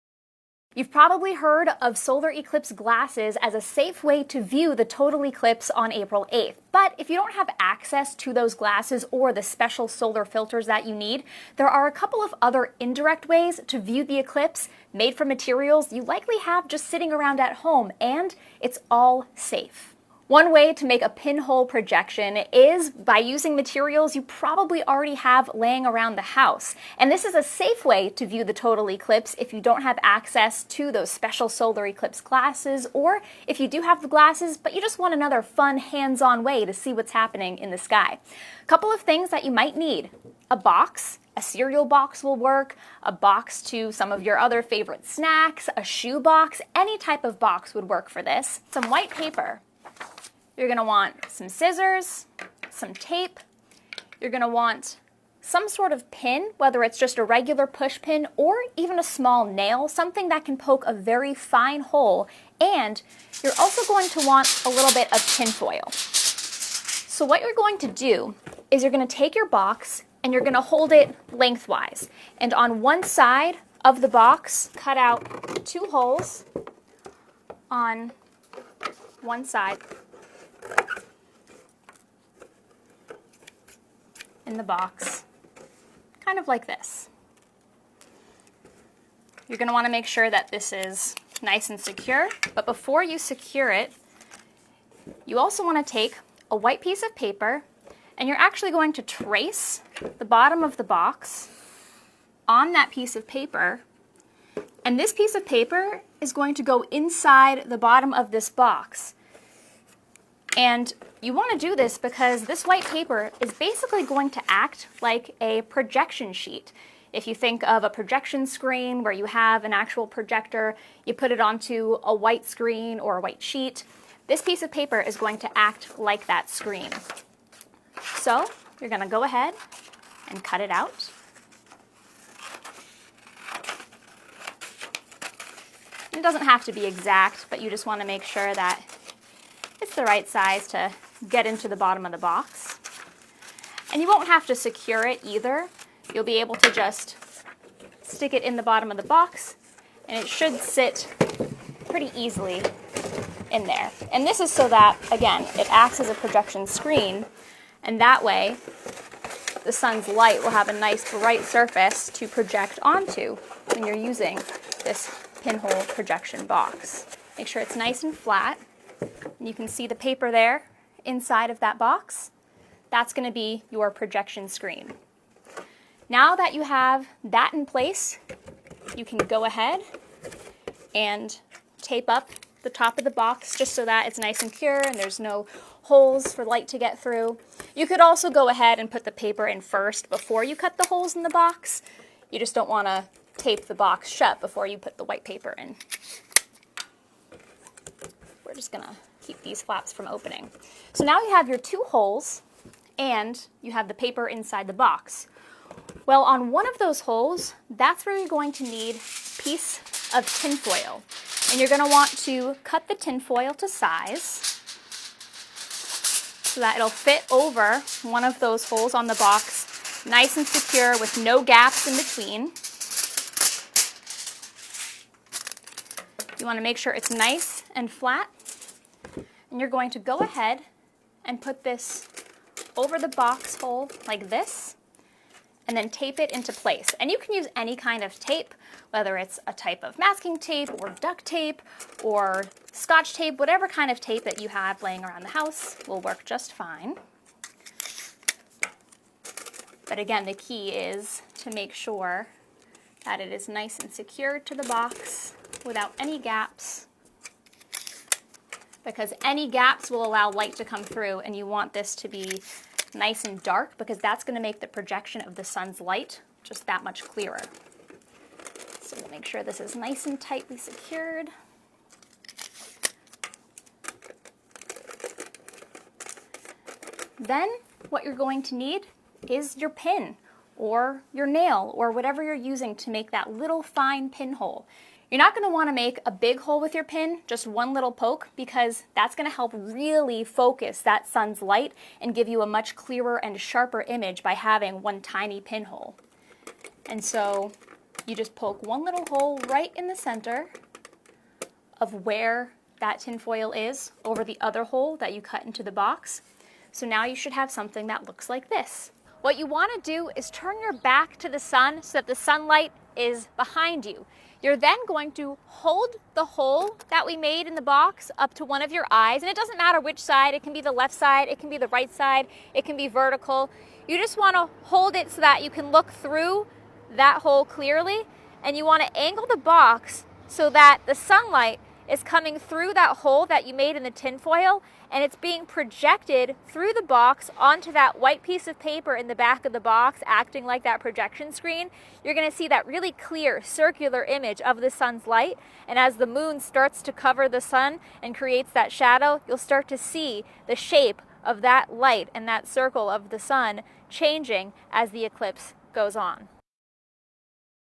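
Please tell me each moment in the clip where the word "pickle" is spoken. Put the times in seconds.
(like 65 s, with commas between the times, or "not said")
not said.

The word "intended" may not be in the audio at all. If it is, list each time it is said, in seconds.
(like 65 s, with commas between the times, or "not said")
not said.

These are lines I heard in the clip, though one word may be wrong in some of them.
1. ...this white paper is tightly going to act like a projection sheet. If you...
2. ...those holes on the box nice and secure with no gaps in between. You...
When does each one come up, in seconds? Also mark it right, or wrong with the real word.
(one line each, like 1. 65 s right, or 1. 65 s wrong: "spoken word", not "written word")
1. 112 s wrong: "basically", not "tightly"
2. 218 s right.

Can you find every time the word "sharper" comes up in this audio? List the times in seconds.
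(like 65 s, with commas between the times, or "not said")
293 s.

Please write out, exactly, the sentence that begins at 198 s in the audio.
We're just going to keep these flaps from opening.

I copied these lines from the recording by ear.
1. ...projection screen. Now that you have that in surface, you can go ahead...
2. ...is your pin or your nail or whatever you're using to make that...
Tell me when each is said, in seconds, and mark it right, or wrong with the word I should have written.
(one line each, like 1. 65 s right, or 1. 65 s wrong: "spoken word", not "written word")
1. 173 s wrong: "place", not "surface"
2. 279 s right.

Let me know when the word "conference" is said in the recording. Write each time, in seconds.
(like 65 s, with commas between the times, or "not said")
not said.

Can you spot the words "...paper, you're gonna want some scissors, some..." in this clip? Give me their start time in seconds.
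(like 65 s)
49 s.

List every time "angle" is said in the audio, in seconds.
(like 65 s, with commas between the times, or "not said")
328 s.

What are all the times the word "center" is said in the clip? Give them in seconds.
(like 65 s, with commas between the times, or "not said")
299 s.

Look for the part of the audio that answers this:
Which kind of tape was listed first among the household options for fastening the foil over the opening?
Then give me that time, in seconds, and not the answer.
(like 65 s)
239 s.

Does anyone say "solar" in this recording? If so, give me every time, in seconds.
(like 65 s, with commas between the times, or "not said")
1 s, 9 s, 31 s.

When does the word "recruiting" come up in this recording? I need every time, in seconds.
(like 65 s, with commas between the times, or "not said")
not said.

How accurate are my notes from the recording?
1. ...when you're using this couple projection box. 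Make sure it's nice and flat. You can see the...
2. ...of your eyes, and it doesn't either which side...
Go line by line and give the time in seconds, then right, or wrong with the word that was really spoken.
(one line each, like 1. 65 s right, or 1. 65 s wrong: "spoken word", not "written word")
1. 163 s wrong: "pinhole", not "couple"
2. 318 s wrong: "matter", not "either".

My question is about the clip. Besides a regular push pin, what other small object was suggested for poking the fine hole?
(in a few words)
A small nail.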